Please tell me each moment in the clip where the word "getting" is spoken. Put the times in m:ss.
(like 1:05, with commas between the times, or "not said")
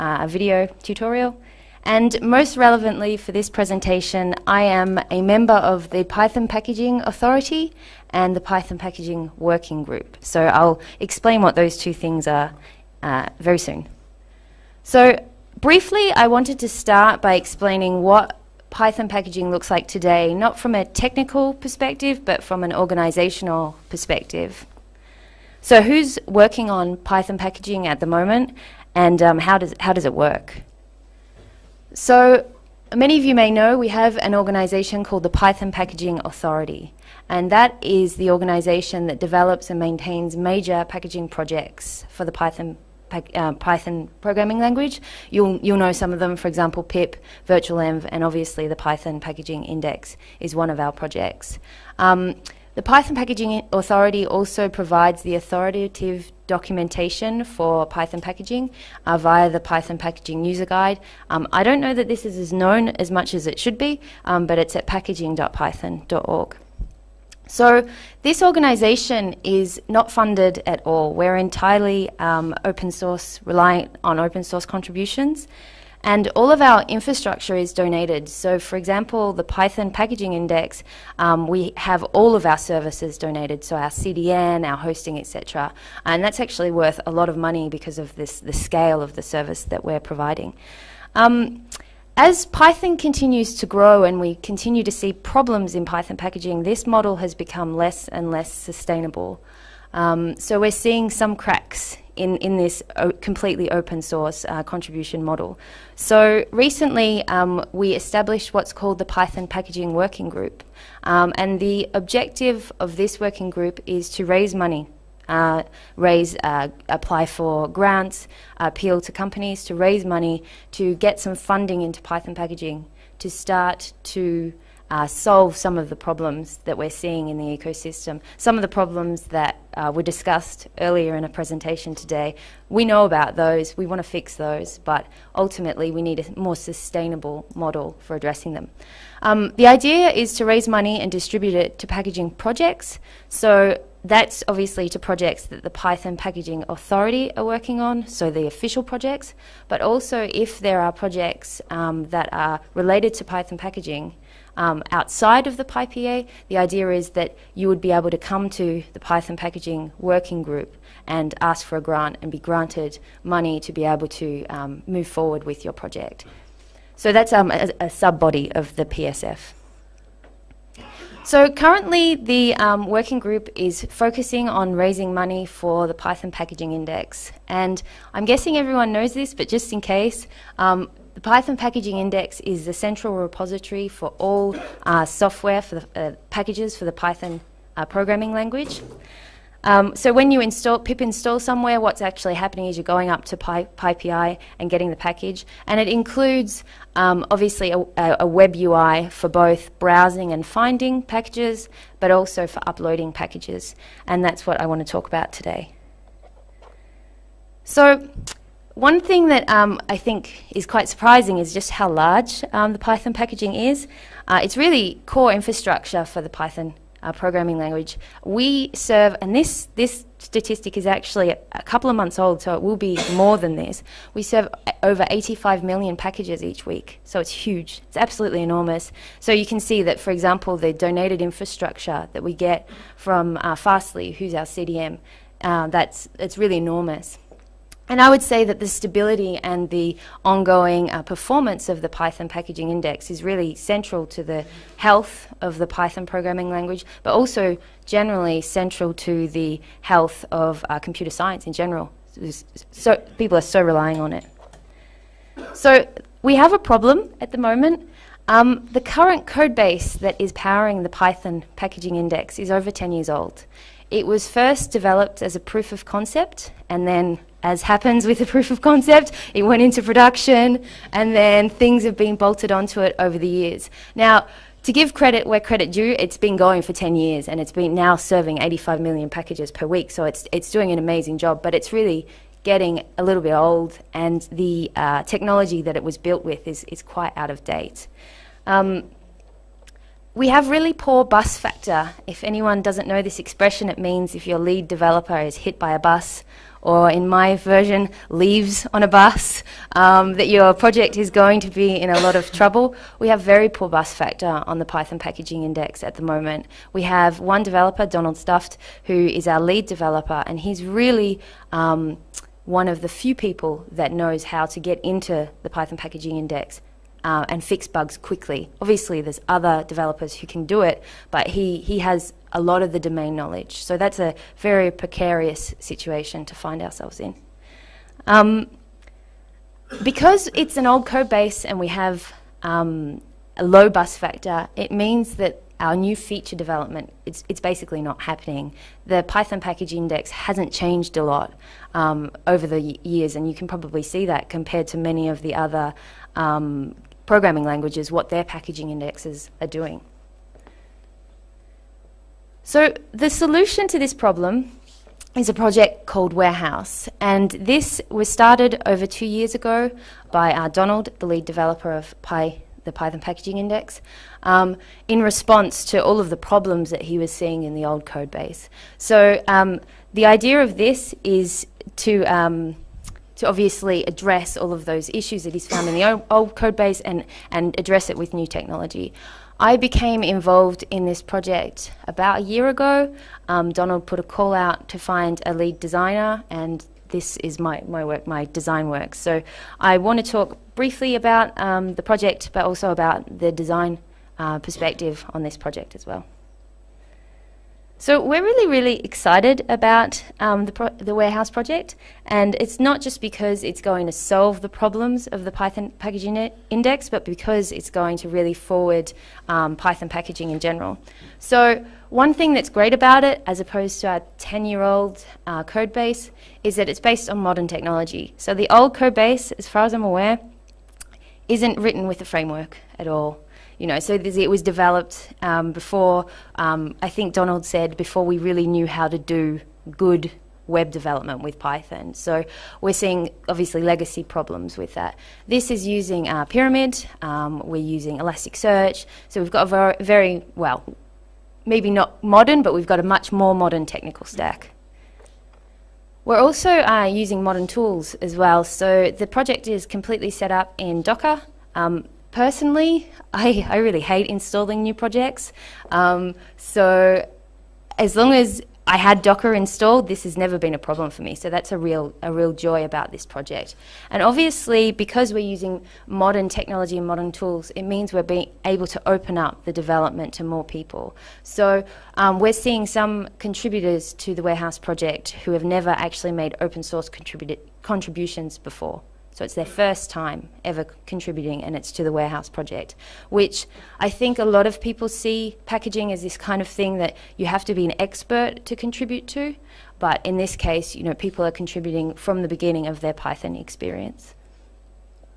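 3:14, 4:42.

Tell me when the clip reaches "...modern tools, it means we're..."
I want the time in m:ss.
7:46.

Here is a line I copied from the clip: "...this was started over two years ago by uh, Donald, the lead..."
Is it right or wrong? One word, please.
right.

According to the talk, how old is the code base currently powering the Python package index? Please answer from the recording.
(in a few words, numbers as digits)
over 10 years.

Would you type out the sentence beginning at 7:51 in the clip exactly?
So um, we're seeing some contributors to the Warehouse project who have never actually made open source contributions before.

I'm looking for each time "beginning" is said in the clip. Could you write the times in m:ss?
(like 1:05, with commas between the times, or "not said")
8:12.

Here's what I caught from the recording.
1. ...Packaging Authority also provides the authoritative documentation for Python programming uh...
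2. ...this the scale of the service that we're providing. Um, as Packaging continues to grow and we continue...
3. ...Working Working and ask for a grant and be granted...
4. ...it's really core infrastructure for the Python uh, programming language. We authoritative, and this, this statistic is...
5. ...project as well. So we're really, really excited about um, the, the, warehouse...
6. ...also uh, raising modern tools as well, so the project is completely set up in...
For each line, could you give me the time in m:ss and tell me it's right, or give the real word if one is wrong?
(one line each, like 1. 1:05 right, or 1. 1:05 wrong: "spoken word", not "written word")
1. 0:53 wrong: "packaging", not "programming"
2. 1:28 wrong: "Python", not "Packaging"
3. 2:39 wrong: "Group", not "Working"
4. 3:34 wrong: "serve", not "authoritative"
5. 6:35 right
6. 7:26 wrong: "using", not "raising".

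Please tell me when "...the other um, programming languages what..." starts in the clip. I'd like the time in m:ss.
5:45.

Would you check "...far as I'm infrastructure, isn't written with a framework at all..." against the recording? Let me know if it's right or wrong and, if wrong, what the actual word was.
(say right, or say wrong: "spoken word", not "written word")
wrong: "aware", not "infrastructure".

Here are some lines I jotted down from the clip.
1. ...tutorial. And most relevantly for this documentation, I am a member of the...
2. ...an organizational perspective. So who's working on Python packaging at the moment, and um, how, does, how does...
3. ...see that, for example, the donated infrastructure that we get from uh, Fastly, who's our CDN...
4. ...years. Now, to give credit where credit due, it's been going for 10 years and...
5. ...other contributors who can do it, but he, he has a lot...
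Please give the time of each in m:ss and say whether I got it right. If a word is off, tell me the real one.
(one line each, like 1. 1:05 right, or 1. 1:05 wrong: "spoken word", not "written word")
1. 0:00 wrong: "presentation", not "documentation"
2. 0:22 right
3. 3:49 right
4. 4:33 right
5. 5:19 wrong: "developers", not "contributors".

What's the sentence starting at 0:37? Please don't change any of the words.
And that is the organization that develops and maintains major packaging projects for the Python uh, Python programming language.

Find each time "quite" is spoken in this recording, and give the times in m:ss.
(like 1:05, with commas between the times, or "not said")
3:30, 4:46.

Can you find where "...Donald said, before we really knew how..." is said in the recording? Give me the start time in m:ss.
7:07.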